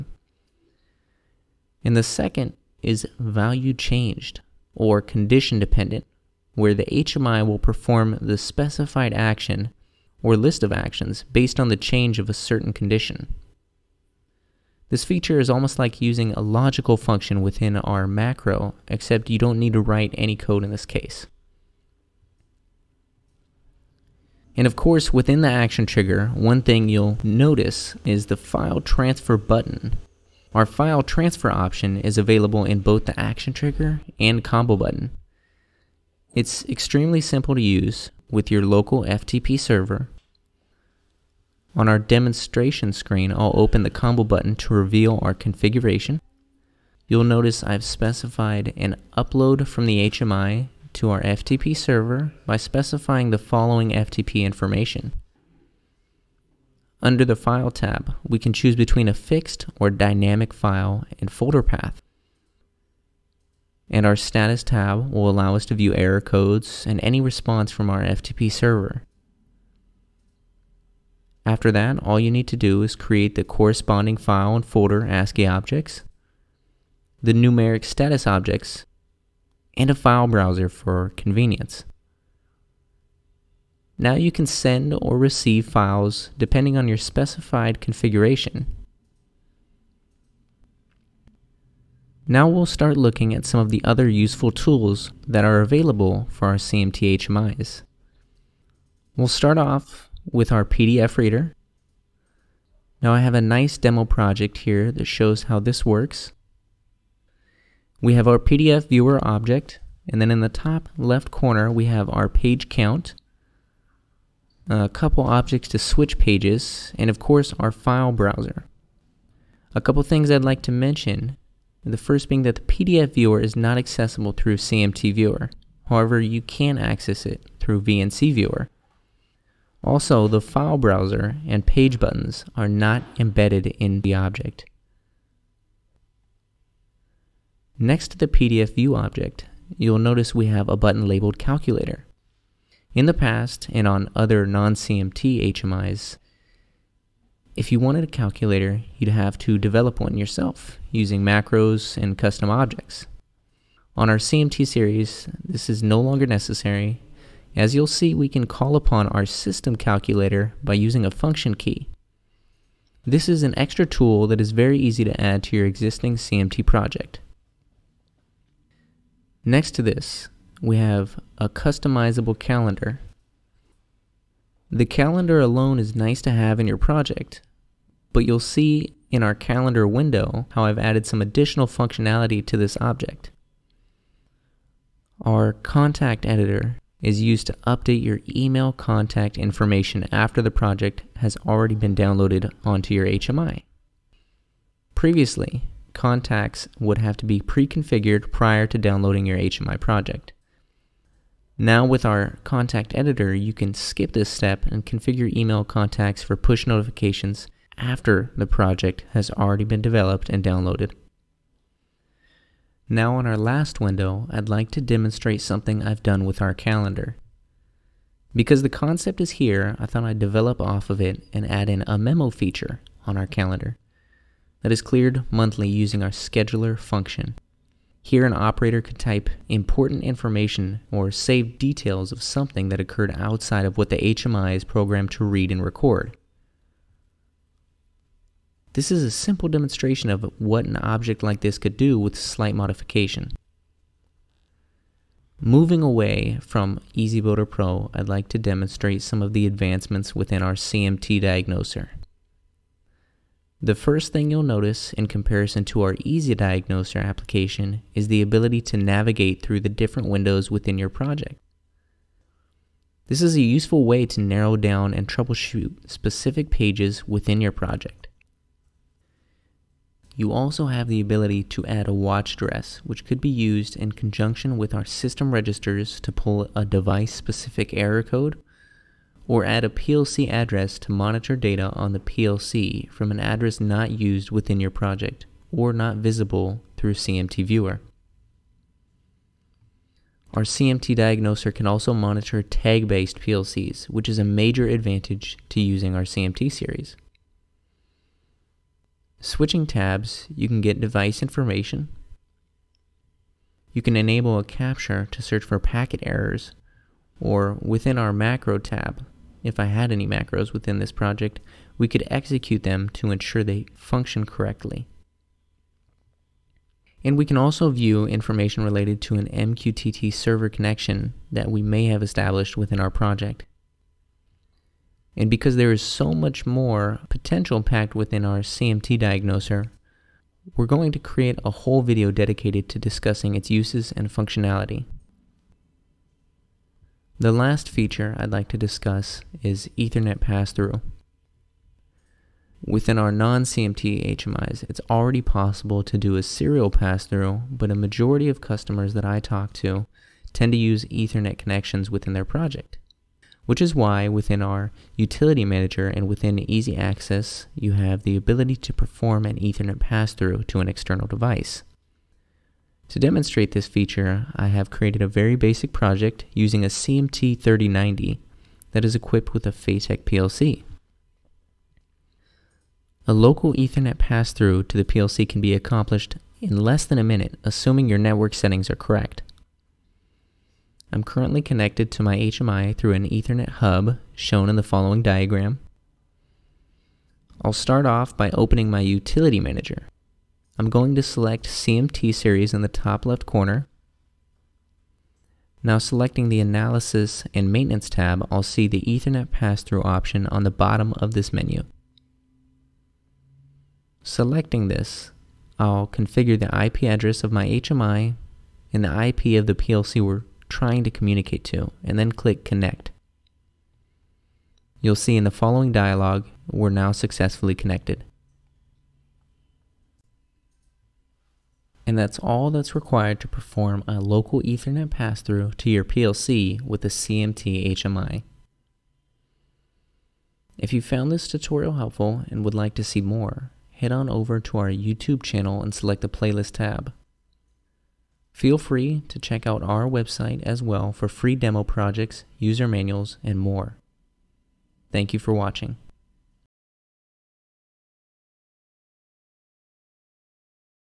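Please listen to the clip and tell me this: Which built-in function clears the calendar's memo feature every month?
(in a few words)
scheduler.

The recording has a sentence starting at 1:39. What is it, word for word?
We'll start off with our PDF reader.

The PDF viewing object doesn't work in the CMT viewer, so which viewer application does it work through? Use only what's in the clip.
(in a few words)
VNC viewer.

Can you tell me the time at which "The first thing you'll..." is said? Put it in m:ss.
4:13.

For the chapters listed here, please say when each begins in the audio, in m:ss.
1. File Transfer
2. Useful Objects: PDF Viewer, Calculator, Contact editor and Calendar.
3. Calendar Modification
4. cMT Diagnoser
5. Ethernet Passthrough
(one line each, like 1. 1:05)
1. 0:20
2. 1:28
3. 3:30
4. 4:03
5. 5:34.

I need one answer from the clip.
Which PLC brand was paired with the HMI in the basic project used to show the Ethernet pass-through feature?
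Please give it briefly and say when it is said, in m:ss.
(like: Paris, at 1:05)
FATEK, at 6:09.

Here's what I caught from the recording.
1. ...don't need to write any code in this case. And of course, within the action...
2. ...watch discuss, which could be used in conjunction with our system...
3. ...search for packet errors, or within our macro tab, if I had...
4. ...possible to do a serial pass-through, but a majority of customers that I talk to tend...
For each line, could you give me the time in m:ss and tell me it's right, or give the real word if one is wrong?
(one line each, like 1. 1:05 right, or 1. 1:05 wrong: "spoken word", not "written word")
1. 0:19 right
2. 4:31 wrong: "address", not "discuss"
3. 5:05 right
4. 5:45 right.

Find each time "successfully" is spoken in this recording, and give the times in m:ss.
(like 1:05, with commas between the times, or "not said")
6:56.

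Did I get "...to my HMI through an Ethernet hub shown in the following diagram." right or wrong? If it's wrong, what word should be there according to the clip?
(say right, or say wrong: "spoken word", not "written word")
right.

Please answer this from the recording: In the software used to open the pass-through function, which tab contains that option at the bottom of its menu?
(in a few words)
Analysis and Maintenance.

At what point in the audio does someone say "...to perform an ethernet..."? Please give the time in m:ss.
5:58.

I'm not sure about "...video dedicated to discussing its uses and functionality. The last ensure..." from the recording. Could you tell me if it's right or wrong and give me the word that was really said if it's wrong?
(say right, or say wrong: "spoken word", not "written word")
wrong: "feature", not "ensure".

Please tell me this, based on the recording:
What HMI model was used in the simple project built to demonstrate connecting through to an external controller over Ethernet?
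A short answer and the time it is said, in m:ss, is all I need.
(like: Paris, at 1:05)
CMT3090, at 6:06.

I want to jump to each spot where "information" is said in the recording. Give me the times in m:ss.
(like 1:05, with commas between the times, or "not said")
0:54, 3:09, 3:50, 5:01, 5:18.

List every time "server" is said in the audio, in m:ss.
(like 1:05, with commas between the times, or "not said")
0:39, 0:51, 1:08, 5:20.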